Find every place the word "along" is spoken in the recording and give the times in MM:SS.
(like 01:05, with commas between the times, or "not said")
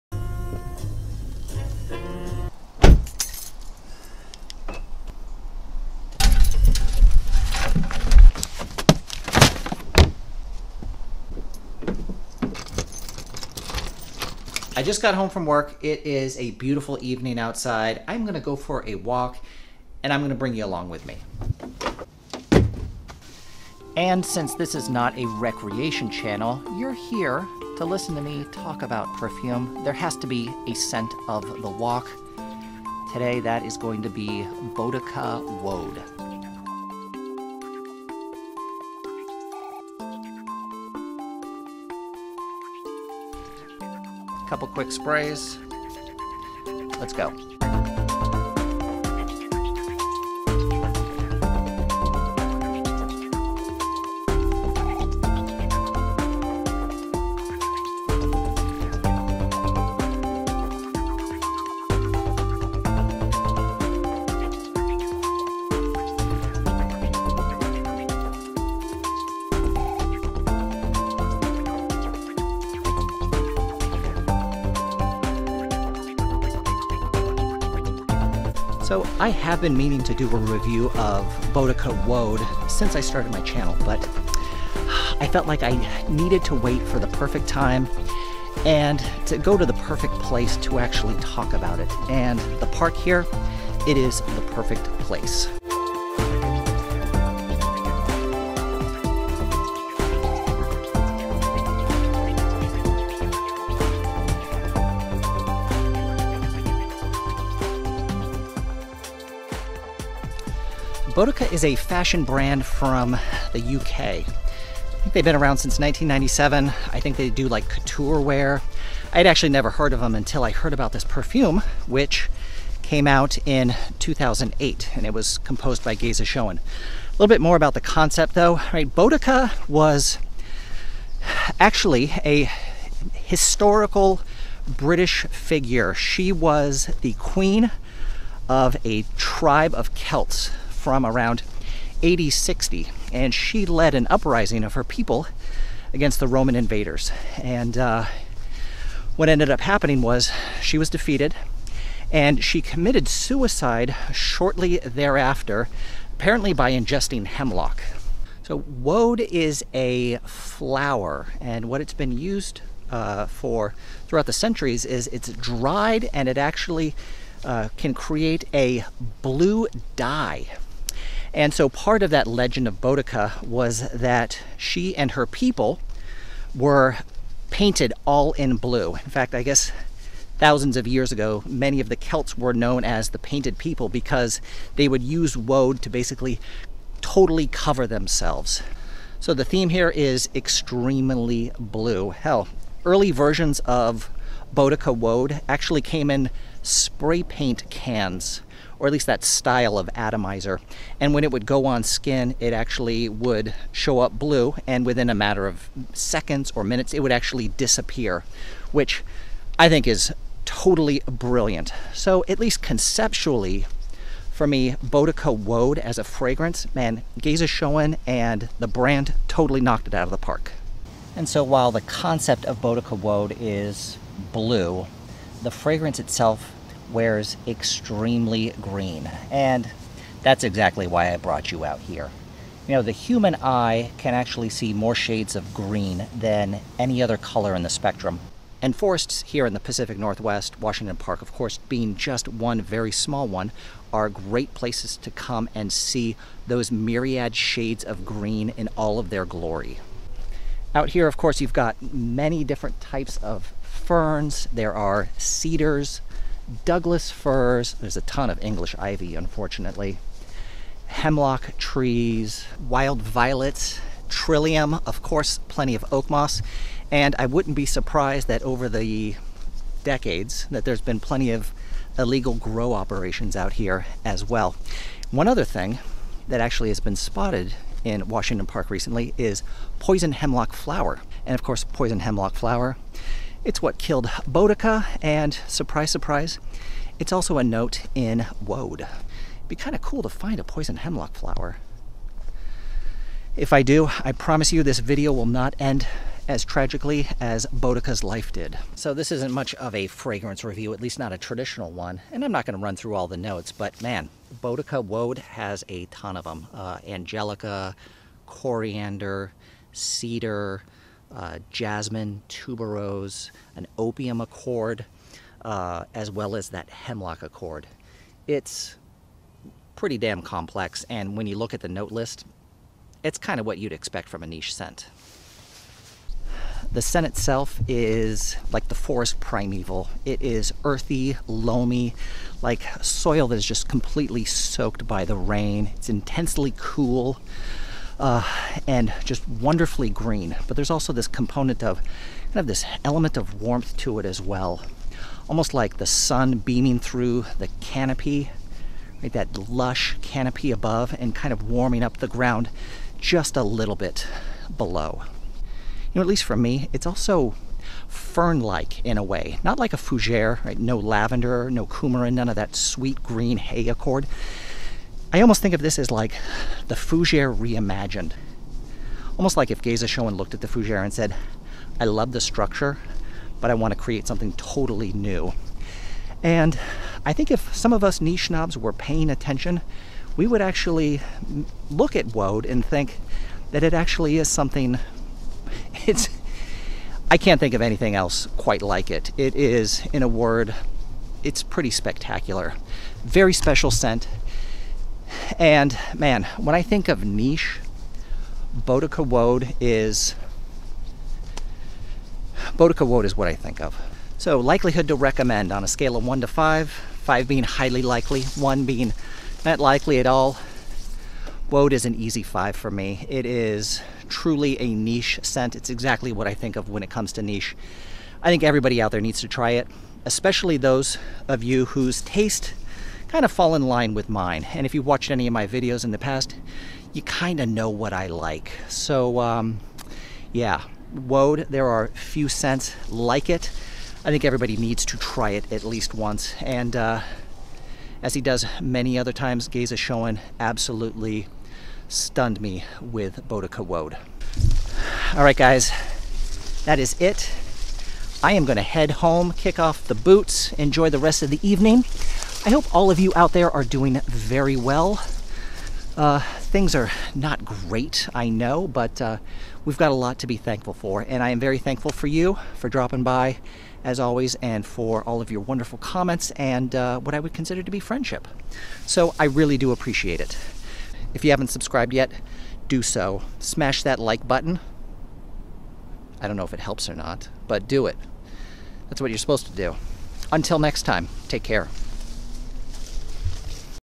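00:20.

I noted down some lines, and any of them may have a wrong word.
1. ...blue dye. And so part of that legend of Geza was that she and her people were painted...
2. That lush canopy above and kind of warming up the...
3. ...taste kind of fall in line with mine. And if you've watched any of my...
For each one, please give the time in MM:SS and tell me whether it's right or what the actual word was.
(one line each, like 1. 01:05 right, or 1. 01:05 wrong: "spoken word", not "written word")
1. 02:49 wrong: "Boudica", not "Geza"
2. 05:49 right
3. 07:02 right.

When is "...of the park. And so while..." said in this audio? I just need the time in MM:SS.
03:40.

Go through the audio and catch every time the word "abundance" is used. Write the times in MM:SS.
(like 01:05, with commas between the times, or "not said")
not said.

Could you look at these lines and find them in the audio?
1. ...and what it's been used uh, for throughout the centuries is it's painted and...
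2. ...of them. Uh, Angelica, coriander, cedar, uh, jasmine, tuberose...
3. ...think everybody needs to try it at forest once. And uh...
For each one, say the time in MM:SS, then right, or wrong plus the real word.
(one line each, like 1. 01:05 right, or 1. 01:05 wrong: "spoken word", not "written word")
1. 02:41 wrong: "dried", not "painted"
2. 05:06 right
3. 07:14 wrong: "least", not "forest".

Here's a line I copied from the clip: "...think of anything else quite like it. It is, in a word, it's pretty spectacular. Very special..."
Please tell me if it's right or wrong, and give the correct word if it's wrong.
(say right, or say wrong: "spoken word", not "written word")
right.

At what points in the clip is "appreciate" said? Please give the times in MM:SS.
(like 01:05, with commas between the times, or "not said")
07:49.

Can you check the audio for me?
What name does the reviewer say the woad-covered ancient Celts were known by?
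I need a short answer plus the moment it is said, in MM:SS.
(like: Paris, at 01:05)
the painted people, at 03:03.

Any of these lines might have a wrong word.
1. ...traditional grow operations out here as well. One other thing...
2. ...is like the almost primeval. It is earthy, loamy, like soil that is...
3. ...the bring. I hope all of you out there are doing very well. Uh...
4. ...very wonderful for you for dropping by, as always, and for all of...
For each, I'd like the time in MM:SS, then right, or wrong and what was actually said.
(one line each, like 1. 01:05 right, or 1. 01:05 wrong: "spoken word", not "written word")
1. 04:31 wrong: "illegal", not "traditional"
2. 05:27 wrong: "forest", not "almost"
3. 07:31 wrong: "evening", not "bring"
4. 07:41 wrong: "thankful", not "wonderful".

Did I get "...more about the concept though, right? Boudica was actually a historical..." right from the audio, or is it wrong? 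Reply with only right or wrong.
right.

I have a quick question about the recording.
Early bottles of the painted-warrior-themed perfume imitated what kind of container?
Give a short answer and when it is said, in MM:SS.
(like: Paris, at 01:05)
spray paint cans, at 03:16.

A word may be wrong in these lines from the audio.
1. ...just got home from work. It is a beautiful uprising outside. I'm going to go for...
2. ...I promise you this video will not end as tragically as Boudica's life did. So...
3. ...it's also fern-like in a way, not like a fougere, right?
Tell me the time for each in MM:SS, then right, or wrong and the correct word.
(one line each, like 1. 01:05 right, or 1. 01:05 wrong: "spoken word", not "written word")
1. 00:14 wrong: "evening", not "uprising"
2. 04:54 right
3. 05:56 right.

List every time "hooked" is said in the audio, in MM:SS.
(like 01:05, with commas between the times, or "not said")
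not said.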